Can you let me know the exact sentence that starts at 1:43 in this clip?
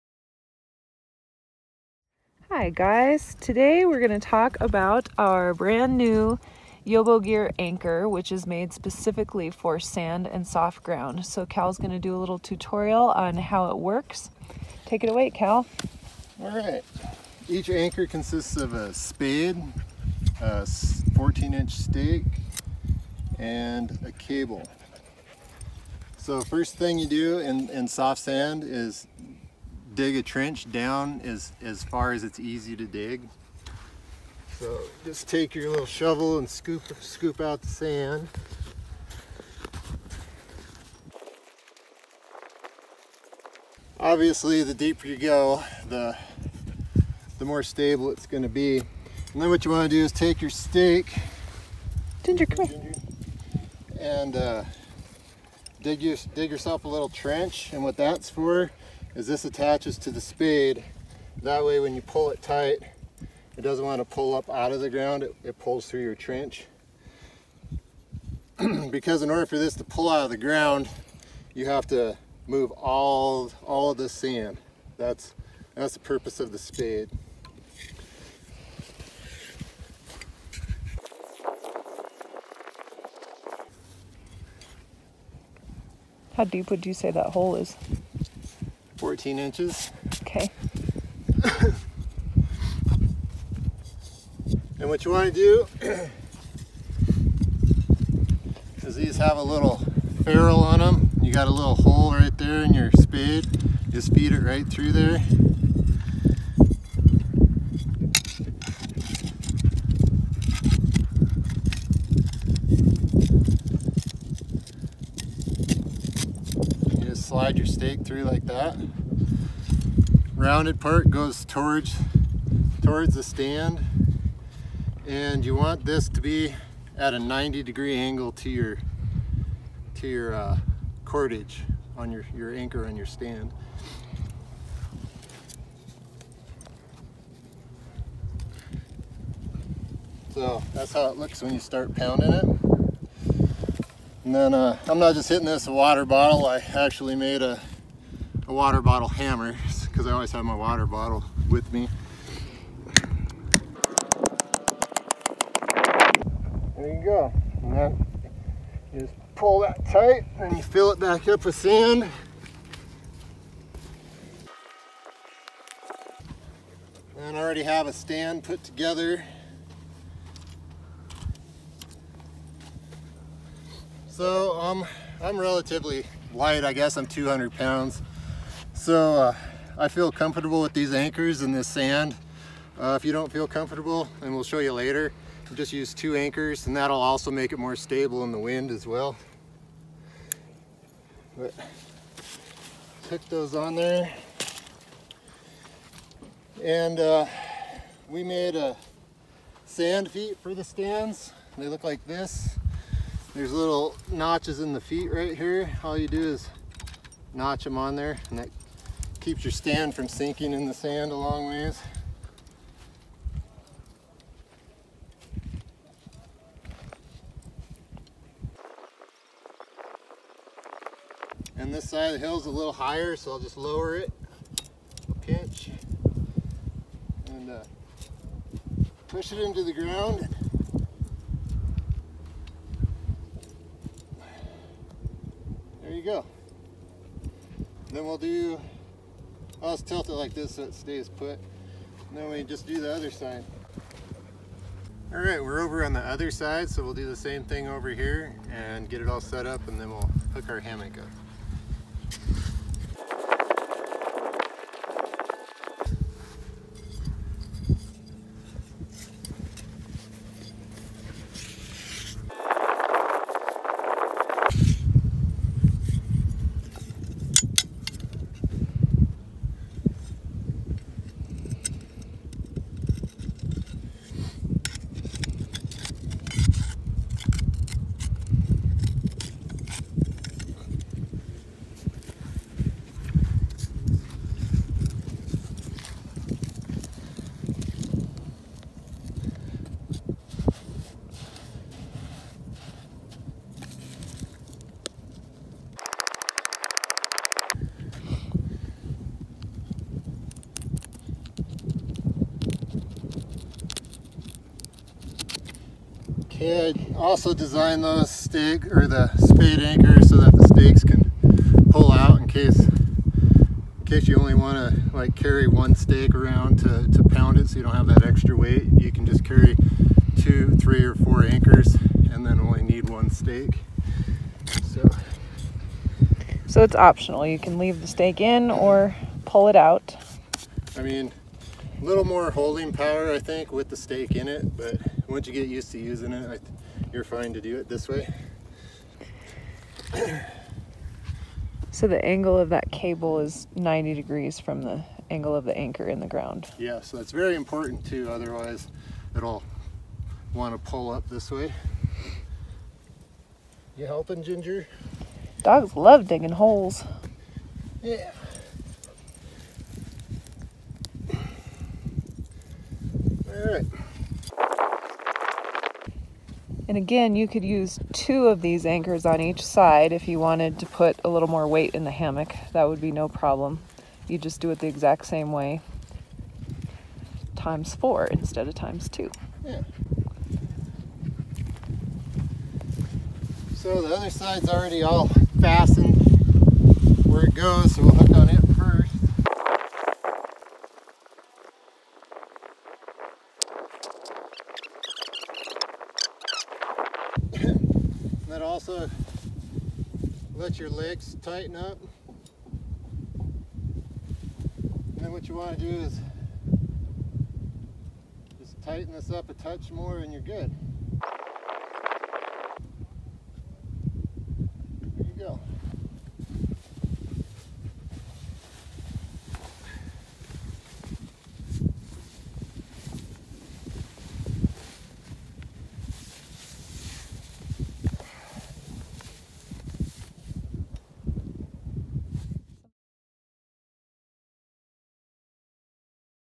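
Just feed it right through there.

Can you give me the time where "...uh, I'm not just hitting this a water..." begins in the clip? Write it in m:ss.
2:24.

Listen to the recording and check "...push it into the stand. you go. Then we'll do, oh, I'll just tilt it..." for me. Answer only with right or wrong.
wrong.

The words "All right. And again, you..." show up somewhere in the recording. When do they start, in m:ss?
6:03.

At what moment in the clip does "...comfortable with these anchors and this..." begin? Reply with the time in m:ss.
3:00.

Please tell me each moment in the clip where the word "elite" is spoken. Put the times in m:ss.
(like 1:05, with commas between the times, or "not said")
not said.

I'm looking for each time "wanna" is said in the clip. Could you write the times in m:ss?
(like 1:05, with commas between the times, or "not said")
0:49.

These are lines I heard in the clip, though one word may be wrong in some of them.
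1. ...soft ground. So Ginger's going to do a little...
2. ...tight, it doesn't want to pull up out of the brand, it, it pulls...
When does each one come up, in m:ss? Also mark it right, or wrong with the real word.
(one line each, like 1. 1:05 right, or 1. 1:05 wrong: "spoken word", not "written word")
1. 0:10 wrong: "Cal", not "Ginger"
2. 1:02 wrong: "ground", not "brand".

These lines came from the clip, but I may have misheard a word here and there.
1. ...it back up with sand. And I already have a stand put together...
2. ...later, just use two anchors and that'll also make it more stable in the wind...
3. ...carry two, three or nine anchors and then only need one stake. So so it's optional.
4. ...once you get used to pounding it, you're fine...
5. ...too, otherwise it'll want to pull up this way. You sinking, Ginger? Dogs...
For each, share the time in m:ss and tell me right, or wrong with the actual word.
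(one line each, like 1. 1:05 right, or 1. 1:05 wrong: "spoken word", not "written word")
1. 2:40 right
2. 3:04 right
3. 5:19 wrong: "four", not "nine"
4. 5:35 wrong: "using", not "pounding"
5. 5:47 wrong: "helping", not "sinking".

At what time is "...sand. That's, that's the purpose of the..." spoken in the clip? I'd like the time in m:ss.
1:14.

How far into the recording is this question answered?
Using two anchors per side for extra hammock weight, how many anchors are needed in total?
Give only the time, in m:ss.
6:17.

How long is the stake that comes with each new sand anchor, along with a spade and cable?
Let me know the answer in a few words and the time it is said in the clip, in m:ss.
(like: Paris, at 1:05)
14 inch, at 0:20.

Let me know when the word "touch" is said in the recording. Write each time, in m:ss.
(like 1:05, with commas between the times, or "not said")
6:49.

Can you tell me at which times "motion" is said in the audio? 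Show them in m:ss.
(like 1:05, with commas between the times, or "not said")
not said.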